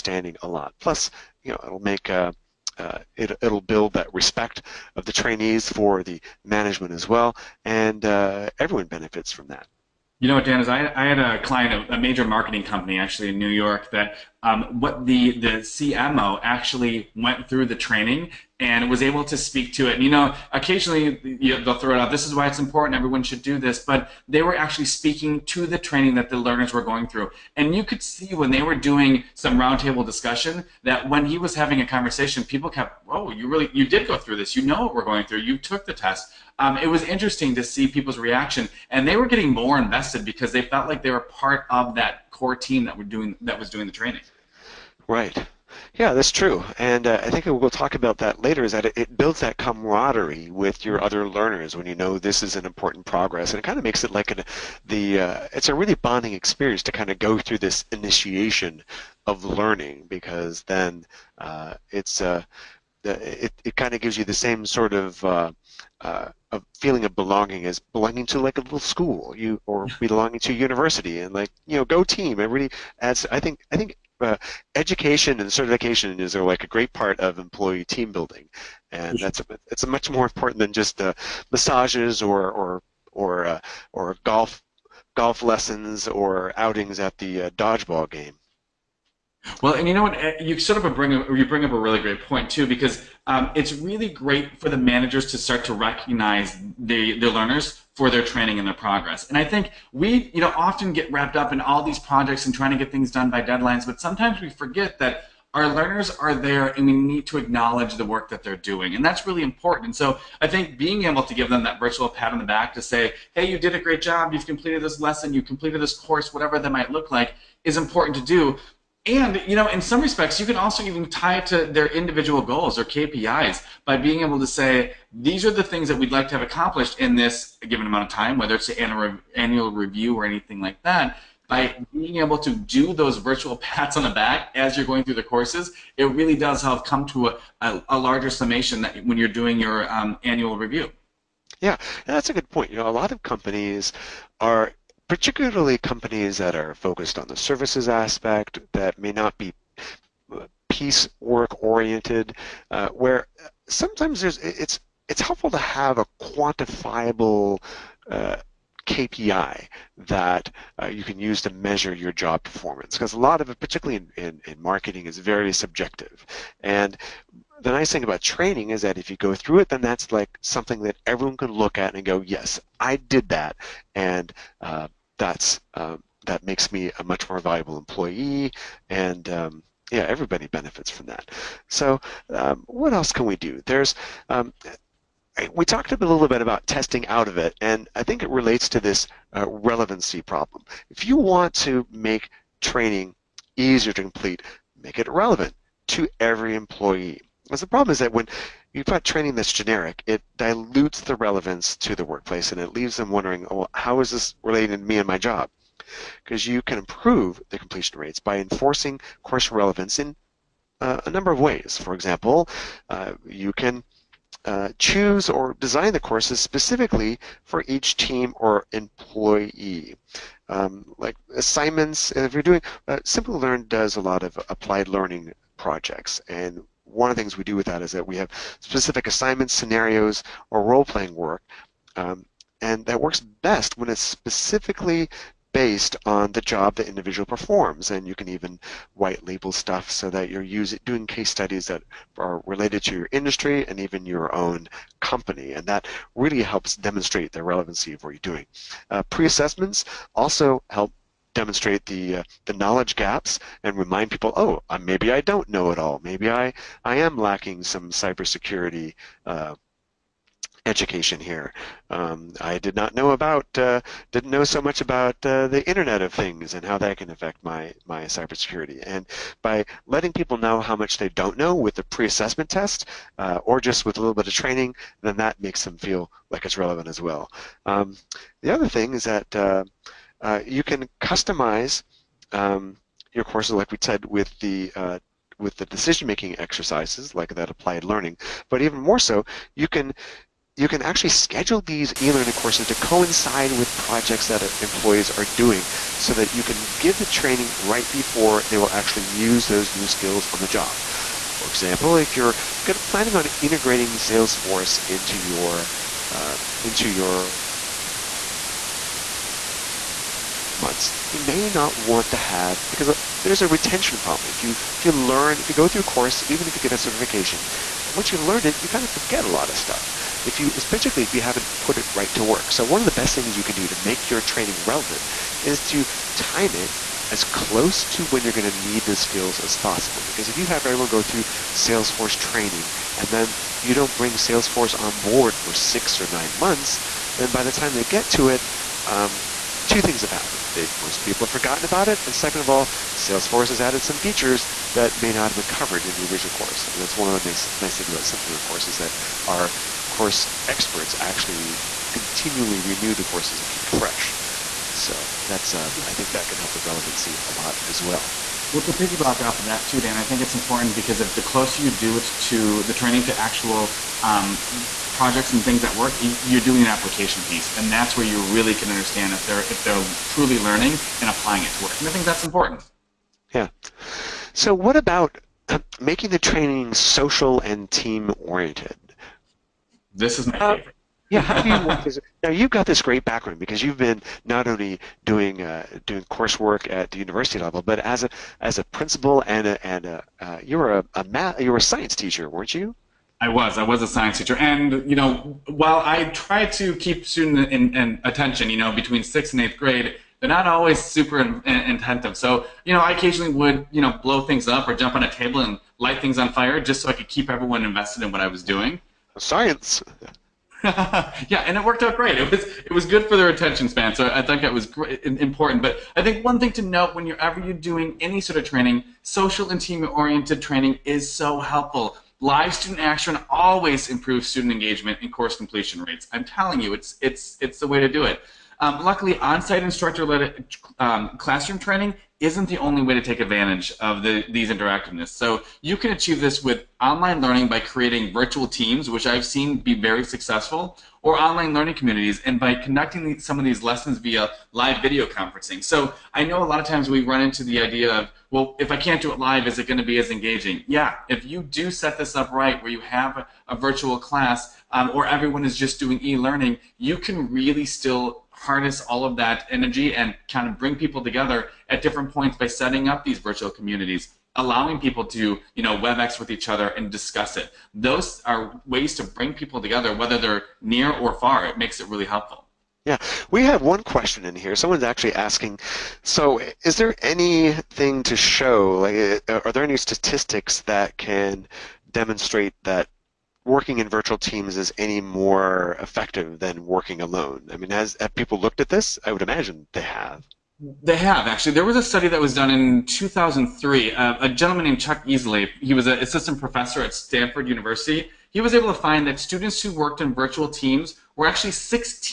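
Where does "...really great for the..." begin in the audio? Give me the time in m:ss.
1:33.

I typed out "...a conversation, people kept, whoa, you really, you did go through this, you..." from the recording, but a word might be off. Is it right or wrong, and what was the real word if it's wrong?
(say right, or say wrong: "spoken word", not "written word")
right.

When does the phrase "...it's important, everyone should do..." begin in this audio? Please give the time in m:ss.
0:22.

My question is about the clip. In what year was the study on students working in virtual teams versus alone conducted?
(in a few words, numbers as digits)
2003.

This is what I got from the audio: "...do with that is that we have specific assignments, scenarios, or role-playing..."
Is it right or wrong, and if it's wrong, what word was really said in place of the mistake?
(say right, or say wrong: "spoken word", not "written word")
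right.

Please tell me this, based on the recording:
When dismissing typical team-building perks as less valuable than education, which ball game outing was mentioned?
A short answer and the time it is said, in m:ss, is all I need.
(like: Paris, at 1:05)
dodgeball, at 1:27.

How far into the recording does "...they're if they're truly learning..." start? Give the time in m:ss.
6:09.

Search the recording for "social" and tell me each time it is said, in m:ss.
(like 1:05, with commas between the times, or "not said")
6:16, 6:59.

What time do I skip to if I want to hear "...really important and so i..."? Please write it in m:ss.
1:49.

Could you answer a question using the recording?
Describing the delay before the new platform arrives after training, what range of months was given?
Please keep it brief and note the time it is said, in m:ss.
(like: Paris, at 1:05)
6 or 9 months, at 5:35.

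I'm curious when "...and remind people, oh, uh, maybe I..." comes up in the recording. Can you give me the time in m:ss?
4:13.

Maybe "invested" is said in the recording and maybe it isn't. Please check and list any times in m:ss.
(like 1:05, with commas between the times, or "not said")
0:39, 6:47.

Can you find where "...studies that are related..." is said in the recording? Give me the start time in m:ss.
4:01.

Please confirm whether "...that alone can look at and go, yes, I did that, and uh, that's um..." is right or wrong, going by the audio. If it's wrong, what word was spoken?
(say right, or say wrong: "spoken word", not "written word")
wrong: "everyone", not "alone".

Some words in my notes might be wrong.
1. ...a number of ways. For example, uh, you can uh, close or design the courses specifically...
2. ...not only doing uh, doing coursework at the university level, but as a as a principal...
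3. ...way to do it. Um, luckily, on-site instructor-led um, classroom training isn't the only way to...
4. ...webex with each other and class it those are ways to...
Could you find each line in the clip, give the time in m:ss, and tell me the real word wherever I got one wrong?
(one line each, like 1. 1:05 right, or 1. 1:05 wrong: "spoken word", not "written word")
1. 3:31 wrong: "choose", not "close"
2. 6:24 right
3. 7:07 right
4. 7:45 wrong: "discuss", not "class".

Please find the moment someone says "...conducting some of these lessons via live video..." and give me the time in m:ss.
7:22.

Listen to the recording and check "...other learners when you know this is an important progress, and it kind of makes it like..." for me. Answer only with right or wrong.
right.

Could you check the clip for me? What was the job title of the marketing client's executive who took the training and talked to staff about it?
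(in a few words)
CMO.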